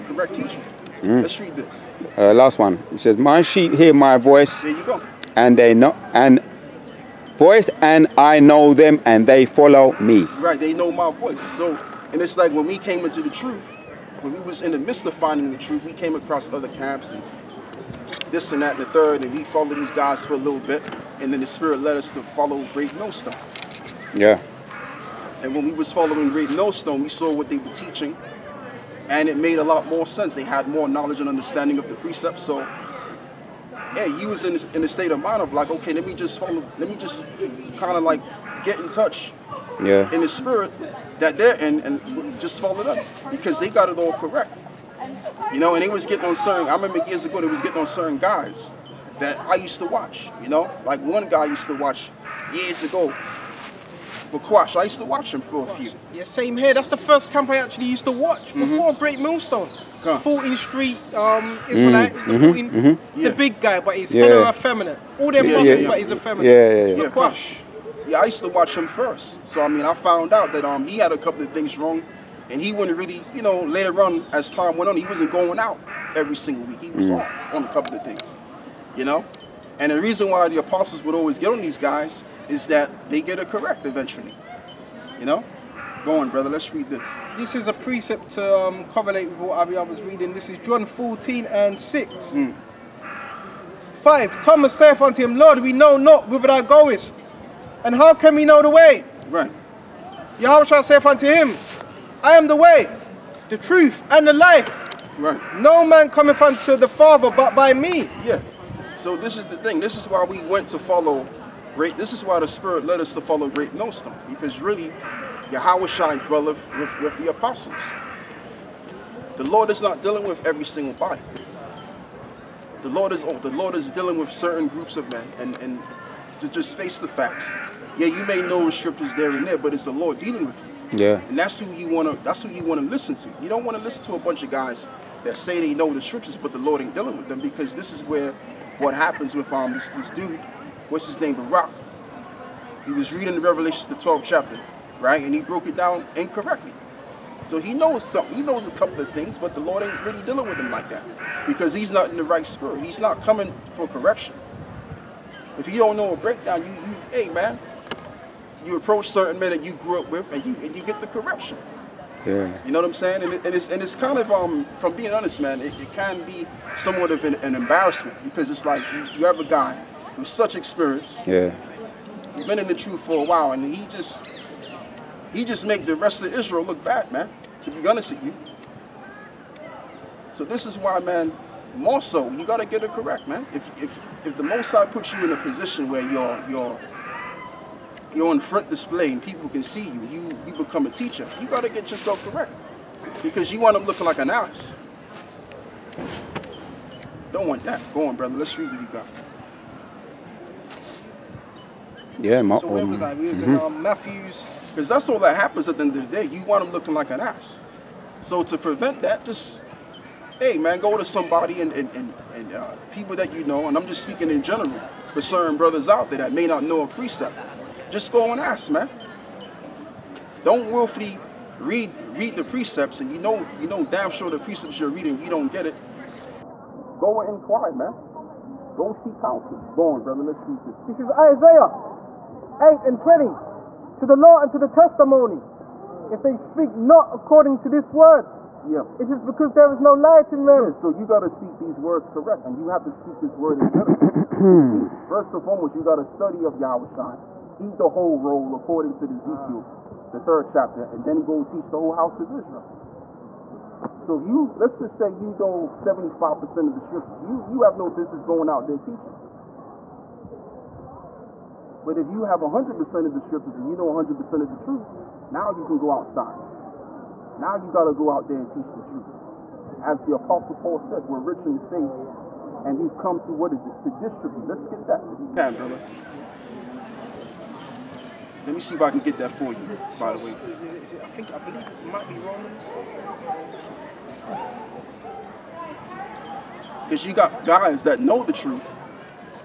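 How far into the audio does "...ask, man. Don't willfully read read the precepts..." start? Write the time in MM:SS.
03:38.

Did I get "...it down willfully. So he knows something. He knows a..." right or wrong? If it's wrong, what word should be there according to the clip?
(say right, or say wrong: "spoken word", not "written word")
wrong: "incorrectly", not "willfully".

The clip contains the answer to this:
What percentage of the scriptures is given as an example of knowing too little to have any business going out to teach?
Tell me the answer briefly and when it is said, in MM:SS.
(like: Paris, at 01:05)
75%, at 04:15.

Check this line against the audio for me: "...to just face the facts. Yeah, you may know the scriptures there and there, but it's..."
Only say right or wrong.
right.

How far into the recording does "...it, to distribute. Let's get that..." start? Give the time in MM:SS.
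04:33.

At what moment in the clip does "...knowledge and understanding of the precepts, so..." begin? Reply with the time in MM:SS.
00:30.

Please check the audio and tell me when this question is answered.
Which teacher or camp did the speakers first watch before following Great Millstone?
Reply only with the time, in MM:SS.
00:54.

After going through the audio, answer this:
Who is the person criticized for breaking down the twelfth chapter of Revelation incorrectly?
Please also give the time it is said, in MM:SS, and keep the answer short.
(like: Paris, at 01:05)
Barak, at 02:21.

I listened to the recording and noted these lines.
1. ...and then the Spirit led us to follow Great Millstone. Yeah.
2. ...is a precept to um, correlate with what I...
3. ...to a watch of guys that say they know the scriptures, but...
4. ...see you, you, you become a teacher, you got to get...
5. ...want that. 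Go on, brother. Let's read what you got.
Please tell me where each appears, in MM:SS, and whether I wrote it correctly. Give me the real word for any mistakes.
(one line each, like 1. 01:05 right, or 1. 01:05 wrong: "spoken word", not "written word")
1. 00:21 right
2. 01:27 right
3. 02:14 wrong: "bunch", not "watch"
4. 03:09 right
5. 03:17 right.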